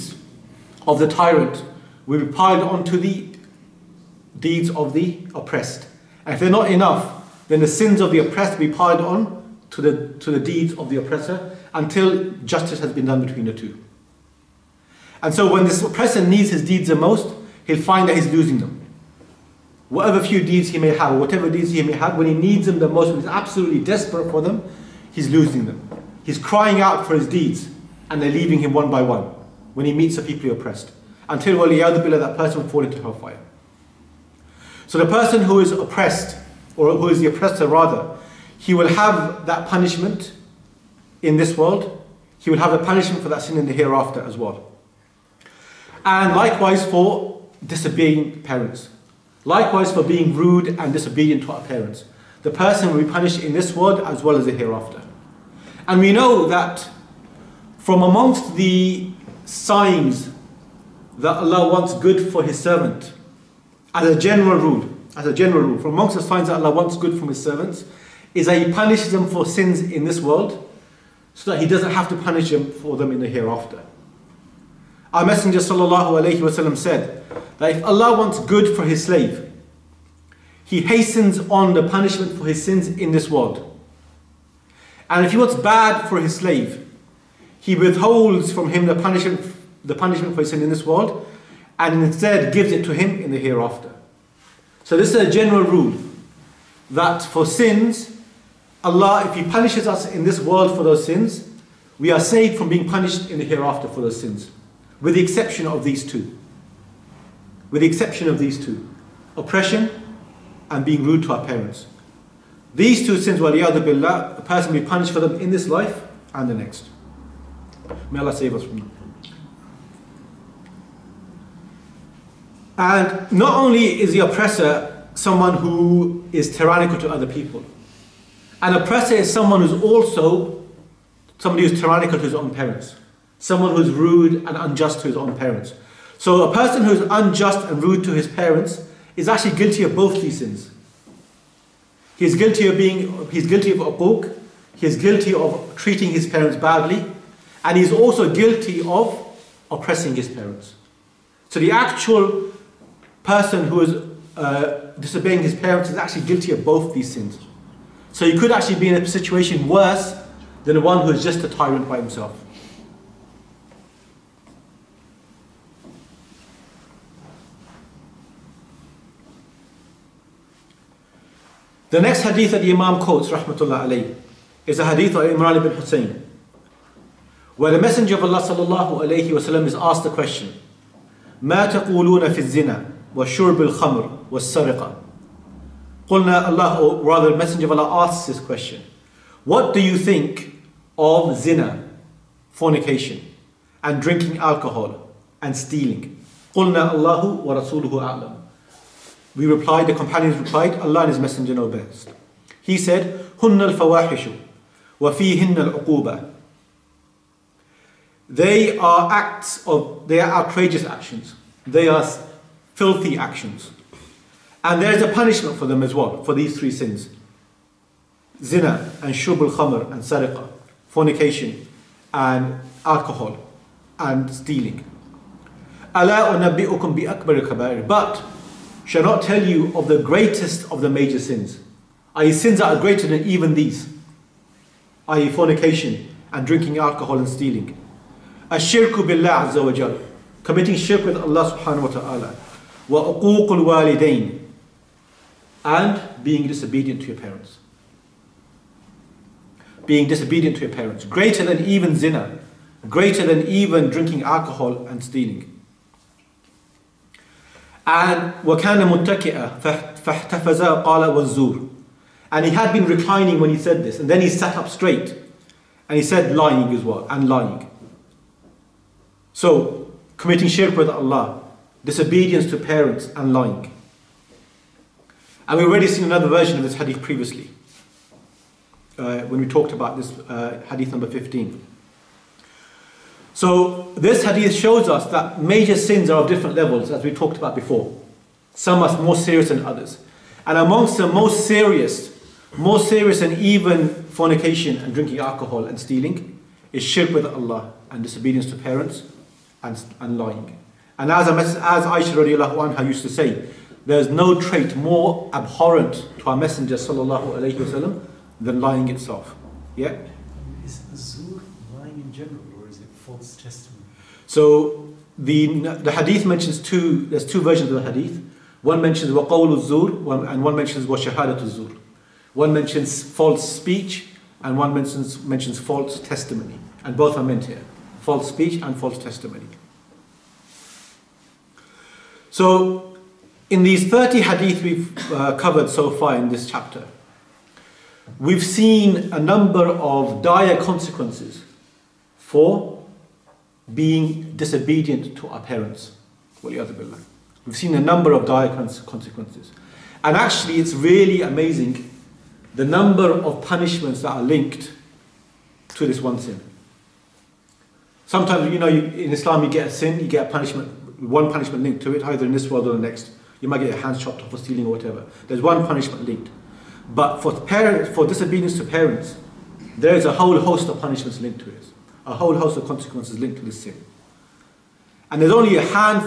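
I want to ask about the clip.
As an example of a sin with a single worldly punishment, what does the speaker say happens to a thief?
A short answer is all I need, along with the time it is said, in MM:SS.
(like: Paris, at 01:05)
Hands chopped off, at 06:03.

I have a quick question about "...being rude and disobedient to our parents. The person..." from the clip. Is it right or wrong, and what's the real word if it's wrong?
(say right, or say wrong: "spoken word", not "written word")
right.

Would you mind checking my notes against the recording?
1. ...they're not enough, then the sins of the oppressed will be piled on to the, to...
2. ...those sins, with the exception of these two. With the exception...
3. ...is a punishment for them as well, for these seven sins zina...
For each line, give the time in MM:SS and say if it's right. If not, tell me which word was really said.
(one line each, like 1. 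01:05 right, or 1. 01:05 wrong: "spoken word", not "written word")
1. 00:06 right
2. 01:44 right
3. 03:34 wrong: "three", not "seven".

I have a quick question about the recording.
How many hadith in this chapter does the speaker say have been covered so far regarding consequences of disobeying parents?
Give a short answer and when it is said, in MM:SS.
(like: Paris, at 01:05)
30, at 05:33.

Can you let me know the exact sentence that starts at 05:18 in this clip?
One mentions waqawlu zur and one mentions wa shahadatu zur.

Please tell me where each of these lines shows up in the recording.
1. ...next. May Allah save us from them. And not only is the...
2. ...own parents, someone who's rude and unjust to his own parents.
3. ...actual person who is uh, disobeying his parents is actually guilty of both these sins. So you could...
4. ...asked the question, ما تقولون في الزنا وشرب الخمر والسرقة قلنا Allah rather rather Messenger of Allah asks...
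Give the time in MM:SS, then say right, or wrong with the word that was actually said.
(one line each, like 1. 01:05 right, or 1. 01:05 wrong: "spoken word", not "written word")
1. 01:56 right
2. 02:12 right
3. 02:31 right
4. 02:59 right.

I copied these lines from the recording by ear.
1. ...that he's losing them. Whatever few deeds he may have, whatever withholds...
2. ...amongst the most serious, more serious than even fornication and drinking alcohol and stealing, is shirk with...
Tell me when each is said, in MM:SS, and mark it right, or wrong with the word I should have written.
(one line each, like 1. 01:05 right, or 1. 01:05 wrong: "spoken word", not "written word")
1. 00:18 wrong: "deeds", not "withholds"
2. 04:50 right.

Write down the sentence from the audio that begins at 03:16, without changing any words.
قلنا الله ورسوله أعلم We replied, the companions replied, Allah and His Messenger know best.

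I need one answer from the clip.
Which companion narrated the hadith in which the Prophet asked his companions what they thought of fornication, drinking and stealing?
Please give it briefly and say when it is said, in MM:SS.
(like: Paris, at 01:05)
Imran ibn Hussein, at 02:55.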